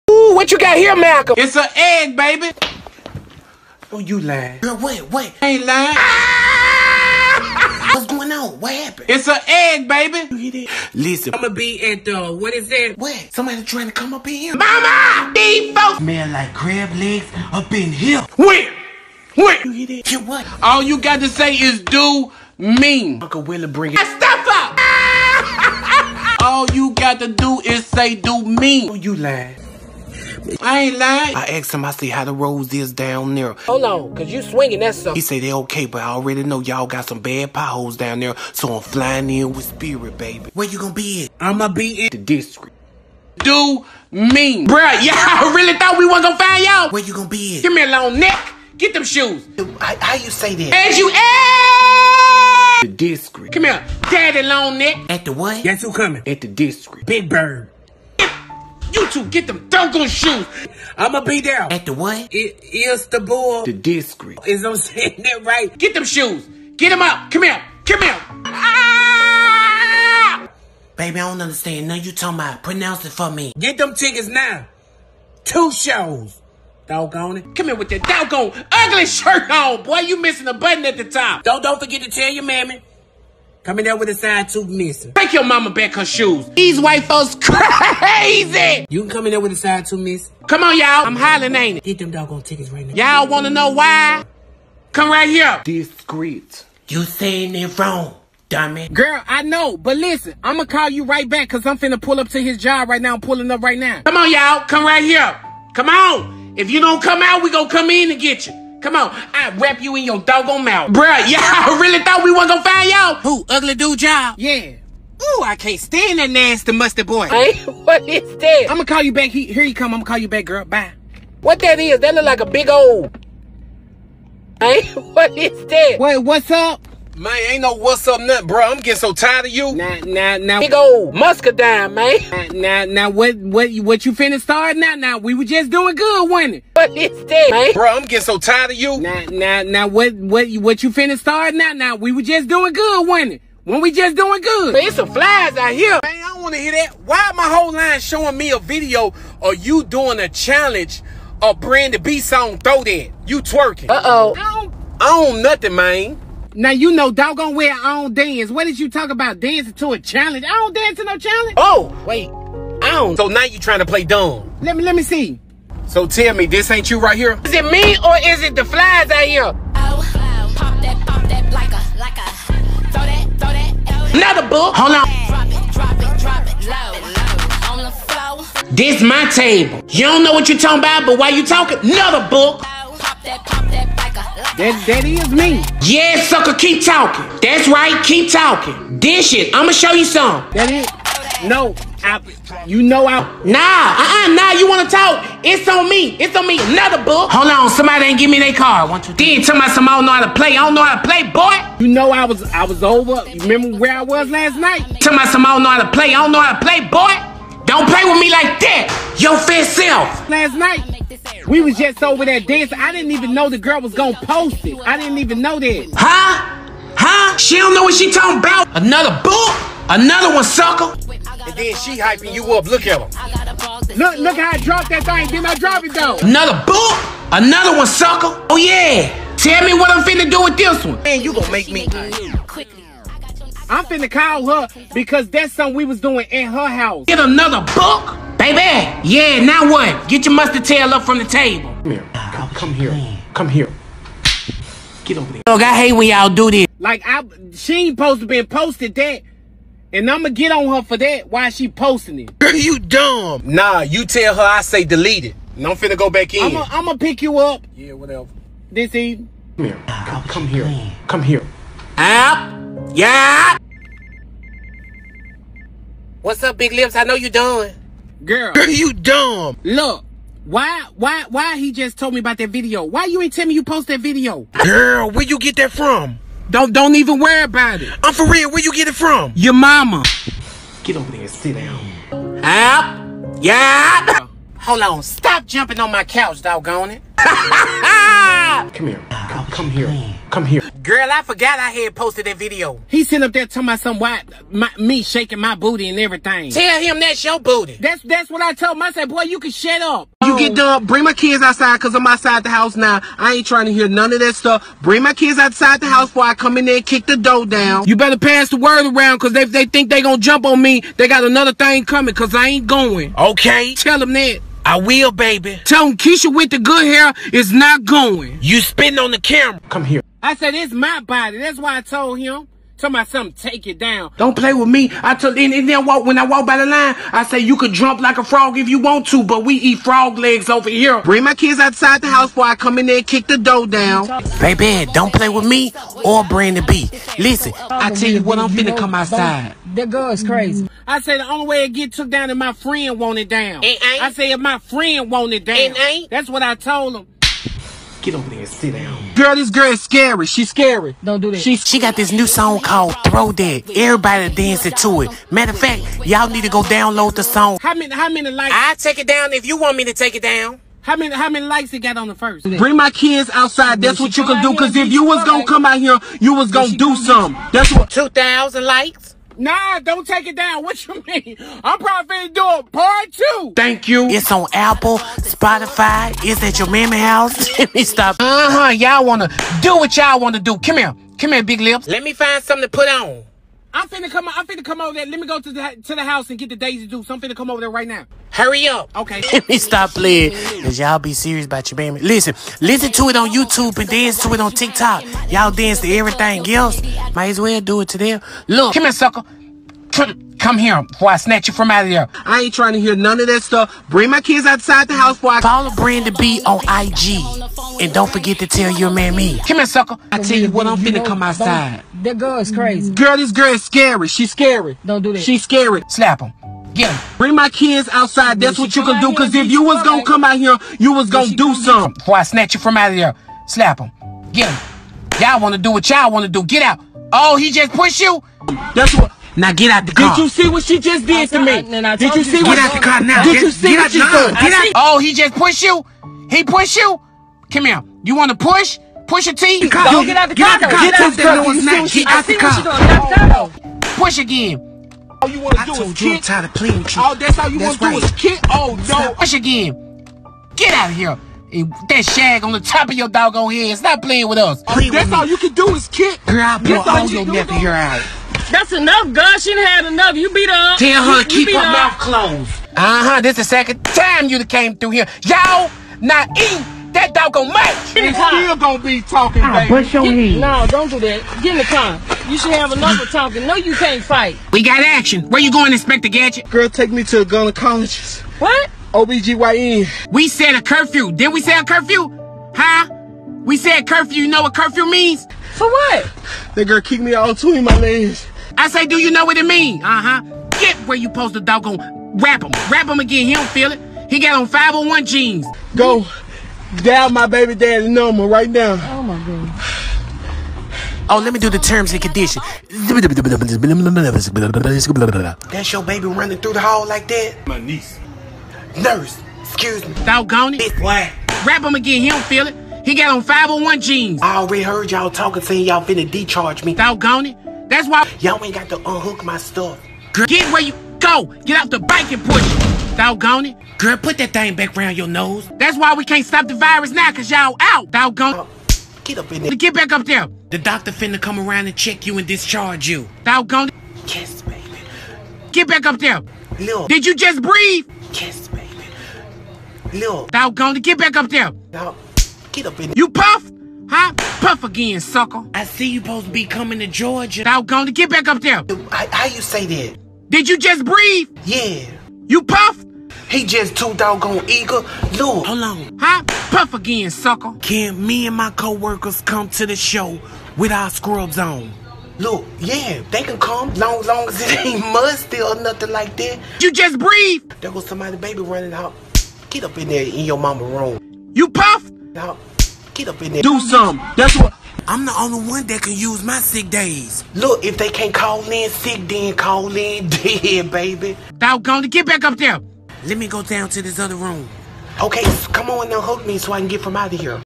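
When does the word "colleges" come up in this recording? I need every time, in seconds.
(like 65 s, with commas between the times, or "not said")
477 s.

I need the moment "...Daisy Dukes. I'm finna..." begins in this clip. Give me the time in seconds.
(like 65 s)
386 s.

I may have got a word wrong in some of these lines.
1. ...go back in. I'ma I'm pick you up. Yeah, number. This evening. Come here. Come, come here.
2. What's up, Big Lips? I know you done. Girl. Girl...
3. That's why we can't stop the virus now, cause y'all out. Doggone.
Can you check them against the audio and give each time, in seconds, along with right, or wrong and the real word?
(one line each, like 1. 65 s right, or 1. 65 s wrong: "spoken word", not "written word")
1. 255 s wrong: "whatever", not "number"
2. 266 s right
3. 525 s right.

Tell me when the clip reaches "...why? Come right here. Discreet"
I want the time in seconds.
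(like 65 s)
93 s.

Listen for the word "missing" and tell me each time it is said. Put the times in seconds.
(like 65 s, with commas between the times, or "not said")
80 s, 84 s, 89 s.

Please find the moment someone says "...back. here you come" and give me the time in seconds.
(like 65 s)
119 s.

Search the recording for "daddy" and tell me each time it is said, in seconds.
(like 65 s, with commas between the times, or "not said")
54 s, 497 s.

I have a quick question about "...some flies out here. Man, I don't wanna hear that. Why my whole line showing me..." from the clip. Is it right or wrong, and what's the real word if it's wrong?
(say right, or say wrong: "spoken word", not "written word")
right.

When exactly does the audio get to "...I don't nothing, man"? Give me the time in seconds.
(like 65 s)
155 s.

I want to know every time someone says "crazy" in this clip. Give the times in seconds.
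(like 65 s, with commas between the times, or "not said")
87 s, 340 s, 412 s.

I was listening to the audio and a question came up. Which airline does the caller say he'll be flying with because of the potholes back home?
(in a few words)
Spirit.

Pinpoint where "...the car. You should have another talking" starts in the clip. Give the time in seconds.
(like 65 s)
471 s.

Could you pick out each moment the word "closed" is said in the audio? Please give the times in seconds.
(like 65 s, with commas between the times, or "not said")
461 s.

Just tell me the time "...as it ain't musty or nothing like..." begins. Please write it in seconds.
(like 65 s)
564 s.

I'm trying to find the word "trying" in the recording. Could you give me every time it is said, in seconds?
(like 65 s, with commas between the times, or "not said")
13 s, 163 s, 303 s, 402 s.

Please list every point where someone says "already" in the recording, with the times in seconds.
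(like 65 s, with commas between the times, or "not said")
36 s, 514 s.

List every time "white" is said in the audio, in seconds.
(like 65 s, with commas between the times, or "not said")
86 s, 293 s.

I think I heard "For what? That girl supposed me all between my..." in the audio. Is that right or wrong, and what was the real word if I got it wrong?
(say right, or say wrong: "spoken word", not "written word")
wrong: "kicked", not "supposed".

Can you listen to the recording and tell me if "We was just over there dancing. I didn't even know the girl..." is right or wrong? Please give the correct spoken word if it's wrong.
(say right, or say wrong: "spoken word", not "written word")
right.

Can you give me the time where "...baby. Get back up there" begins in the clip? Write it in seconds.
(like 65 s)
534 s.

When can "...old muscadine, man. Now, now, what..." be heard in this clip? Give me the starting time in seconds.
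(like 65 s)
130 s.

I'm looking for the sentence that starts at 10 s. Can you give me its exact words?
Listen, I'ma be at the, what is that?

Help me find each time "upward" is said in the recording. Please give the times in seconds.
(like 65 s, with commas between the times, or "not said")
not said.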